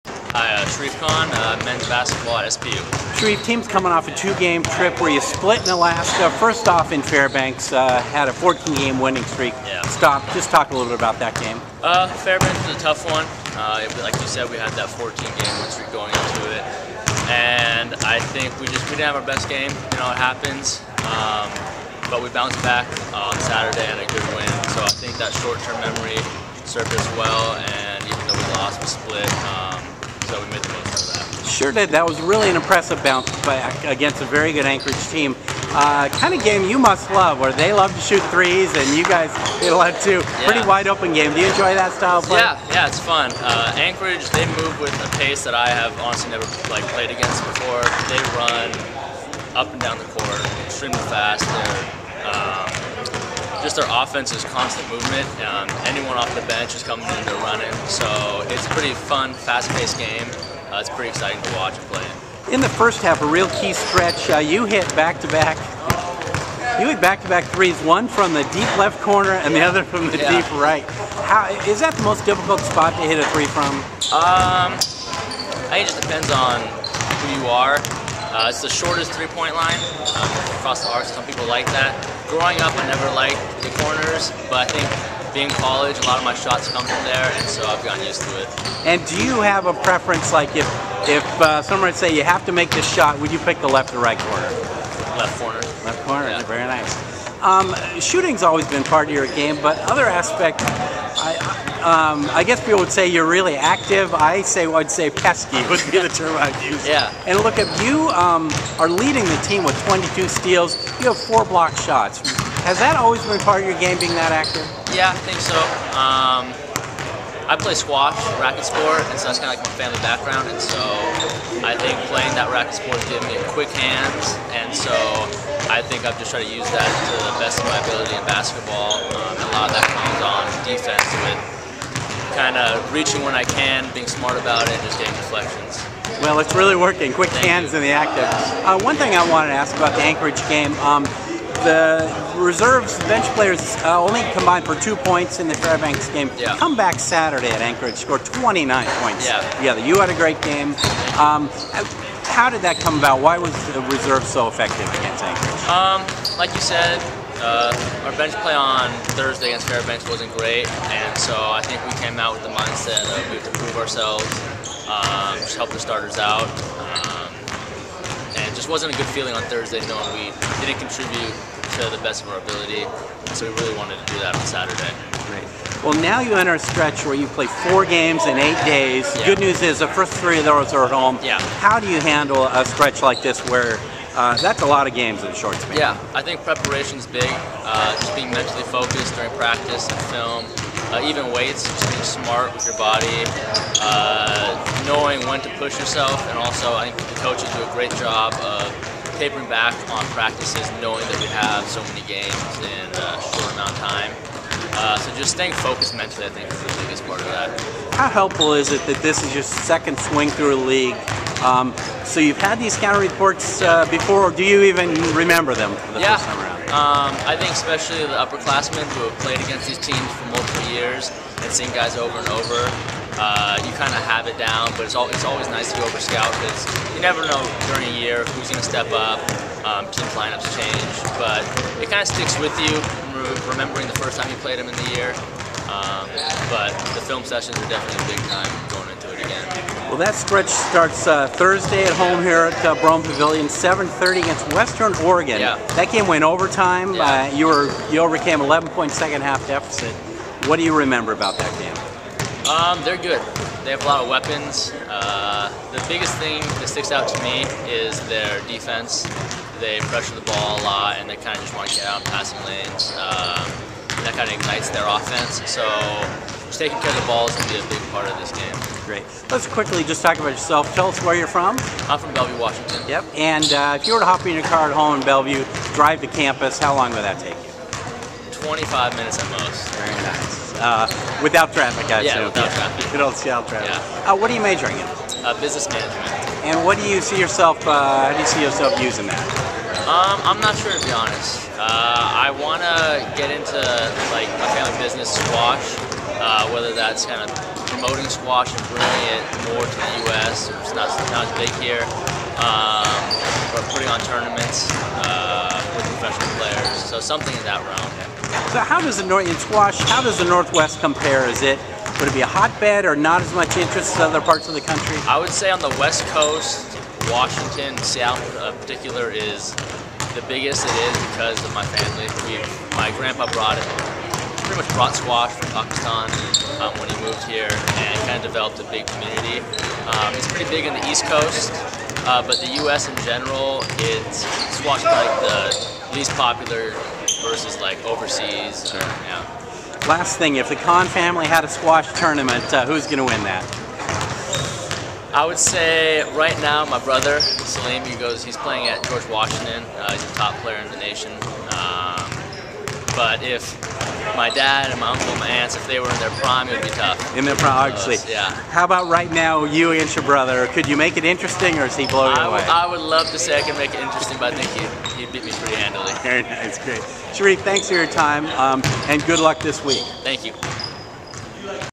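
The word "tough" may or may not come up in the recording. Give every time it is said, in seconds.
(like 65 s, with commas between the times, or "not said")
12 s, 356 s.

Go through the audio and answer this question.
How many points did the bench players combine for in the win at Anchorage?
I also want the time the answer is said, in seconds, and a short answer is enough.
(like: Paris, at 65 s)
29, at 147 s.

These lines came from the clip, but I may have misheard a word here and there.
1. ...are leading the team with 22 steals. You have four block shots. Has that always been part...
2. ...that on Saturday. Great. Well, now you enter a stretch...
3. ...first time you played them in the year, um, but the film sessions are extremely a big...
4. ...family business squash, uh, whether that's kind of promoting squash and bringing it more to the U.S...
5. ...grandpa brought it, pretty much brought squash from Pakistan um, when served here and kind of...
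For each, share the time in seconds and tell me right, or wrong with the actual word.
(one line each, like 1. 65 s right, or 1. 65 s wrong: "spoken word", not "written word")
1. 108 s right
2. 174 s right
3. 233 s wrong: "definitely", not "extremely"
4. 294 s right
5. 322 s wrong: "moved", not "served".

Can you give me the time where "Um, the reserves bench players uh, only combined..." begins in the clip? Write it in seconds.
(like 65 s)
140 s.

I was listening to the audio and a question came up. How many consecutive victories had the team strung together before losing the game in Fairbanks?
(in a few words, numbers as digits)
14.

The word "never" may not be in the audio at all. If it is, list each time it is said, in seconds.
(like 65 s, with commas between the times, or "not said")
46 s, 82 s, 227 s.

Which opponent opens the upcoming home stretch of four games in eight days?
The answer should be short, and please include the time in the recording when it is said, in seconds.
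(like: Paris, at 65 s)
Western Oregon, at 244 s.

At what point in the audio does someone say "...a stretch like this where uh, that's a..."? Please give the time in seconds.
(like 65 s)
182 s.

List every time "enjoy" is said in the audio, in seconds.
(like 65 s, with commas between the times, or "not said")
41 s.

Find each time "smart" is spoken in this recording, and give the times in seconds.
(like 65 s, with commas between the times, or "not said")
134 s, 192 s.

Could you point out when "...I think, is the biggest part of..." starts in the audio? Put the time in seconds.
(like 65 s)
206 s.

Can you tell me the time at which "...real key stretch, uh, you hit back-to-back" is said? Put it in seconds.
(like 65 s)
63 s.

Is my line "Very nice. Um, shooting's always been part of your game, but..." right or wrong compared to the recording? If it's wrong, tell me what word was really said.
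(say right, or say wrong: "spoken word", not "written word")
right.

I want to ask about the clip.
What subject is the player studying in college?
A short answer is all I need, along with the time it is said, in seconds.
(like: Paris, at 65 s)
Business management, at 285 s.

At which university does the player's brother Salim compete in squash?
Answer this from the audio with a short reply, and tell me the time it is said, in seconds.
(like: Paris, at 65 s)
George Washington, at 348 s.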